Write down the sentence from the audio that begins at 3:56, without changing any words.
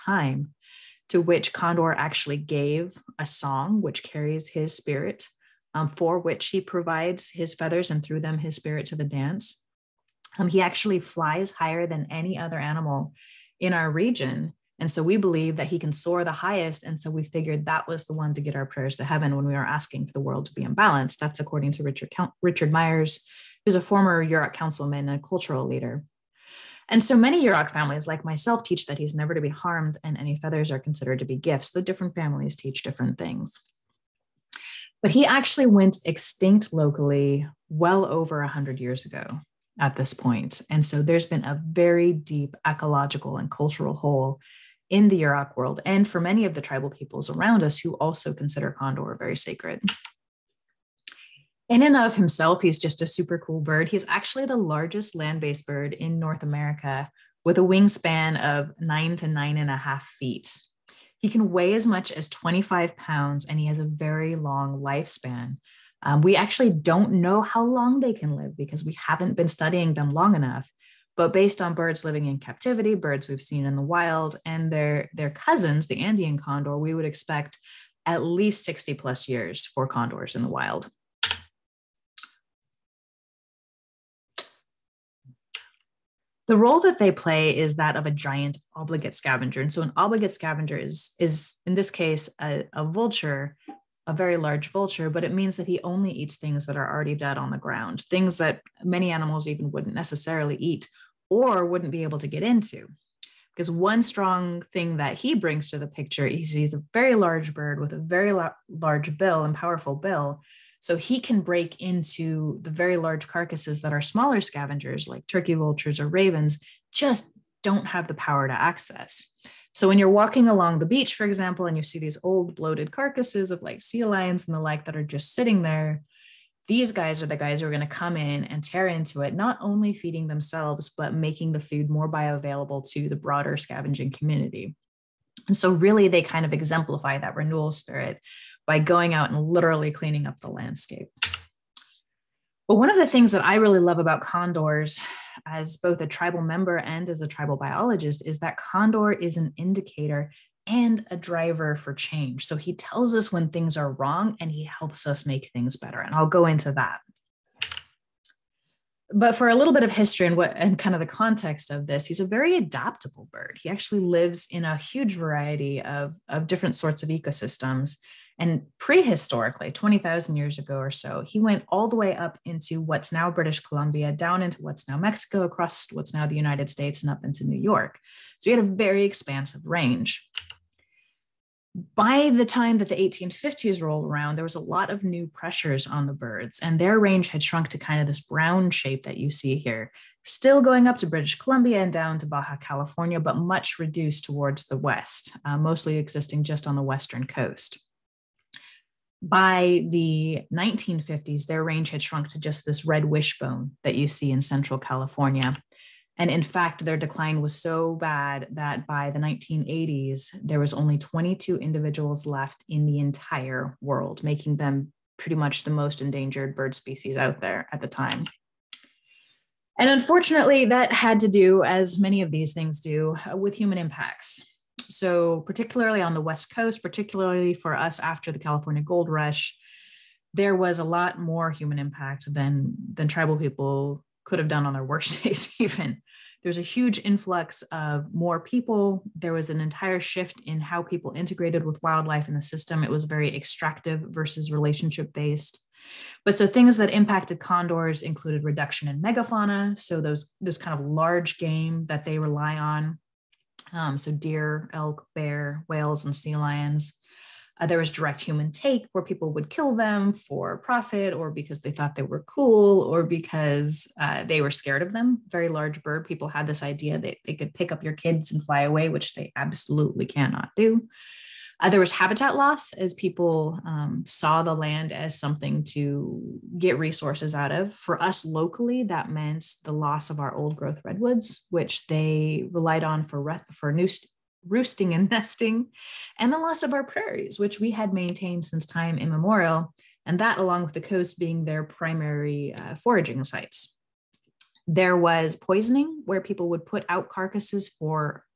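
There's a huge influx of more people.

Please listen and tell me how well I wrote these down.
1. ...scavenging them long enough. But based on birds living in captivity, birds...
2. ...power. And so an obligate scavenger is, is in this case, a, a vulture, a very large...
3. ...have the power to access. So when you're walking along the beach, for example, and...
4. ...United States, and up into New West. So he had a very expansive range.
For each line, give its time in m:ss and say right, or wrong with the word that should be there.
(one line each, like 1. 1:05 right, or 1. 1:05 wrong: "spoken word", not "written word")
1. 1:09 wrong: "studying", not "scavenging"
2. 1:29 wrong: "scavenger", not "power"
3. 1:57 right
4. 2:56 wrong: "York", not "West".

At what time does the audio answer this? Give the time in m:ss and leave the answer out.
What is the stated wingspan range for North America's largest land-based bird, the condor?
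0:58.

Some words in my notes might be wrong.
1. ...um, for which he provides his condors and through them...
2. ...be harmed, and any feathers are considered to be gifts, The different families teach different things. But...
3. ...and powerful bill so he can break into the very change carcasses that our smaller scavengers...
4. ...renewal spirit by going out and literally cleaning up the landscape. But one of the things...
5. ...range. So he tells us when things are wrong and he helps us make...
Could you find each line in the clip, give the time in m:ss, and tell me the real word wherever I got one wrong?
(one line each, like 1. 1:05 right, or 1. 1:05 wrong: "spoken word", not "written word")
1. 0:05 wrong: "feathers", not "condors"
2. 0:29 right
3. 1:49 wrong: "large", not "change"
4. 2:17 right
5. 2:31 wrong: "change", not "range".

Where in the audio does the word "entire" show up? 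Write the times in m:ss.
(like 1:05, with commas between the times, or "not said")
3:32, 3:59.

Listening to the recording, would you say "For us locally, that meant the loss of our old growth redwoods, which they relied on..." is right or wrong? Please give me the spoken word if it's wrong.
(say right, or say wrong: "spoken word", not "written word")
right.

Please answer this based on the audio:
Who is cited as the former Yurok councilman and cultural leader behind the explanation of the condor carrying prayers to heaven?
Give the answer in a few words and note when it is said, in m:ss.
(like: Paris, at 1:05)
Richard Myers, at 0:22.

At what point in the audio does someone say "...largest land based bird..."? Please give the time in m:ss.
0:54.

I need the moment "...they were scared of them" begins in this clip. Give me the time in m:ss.
4:24.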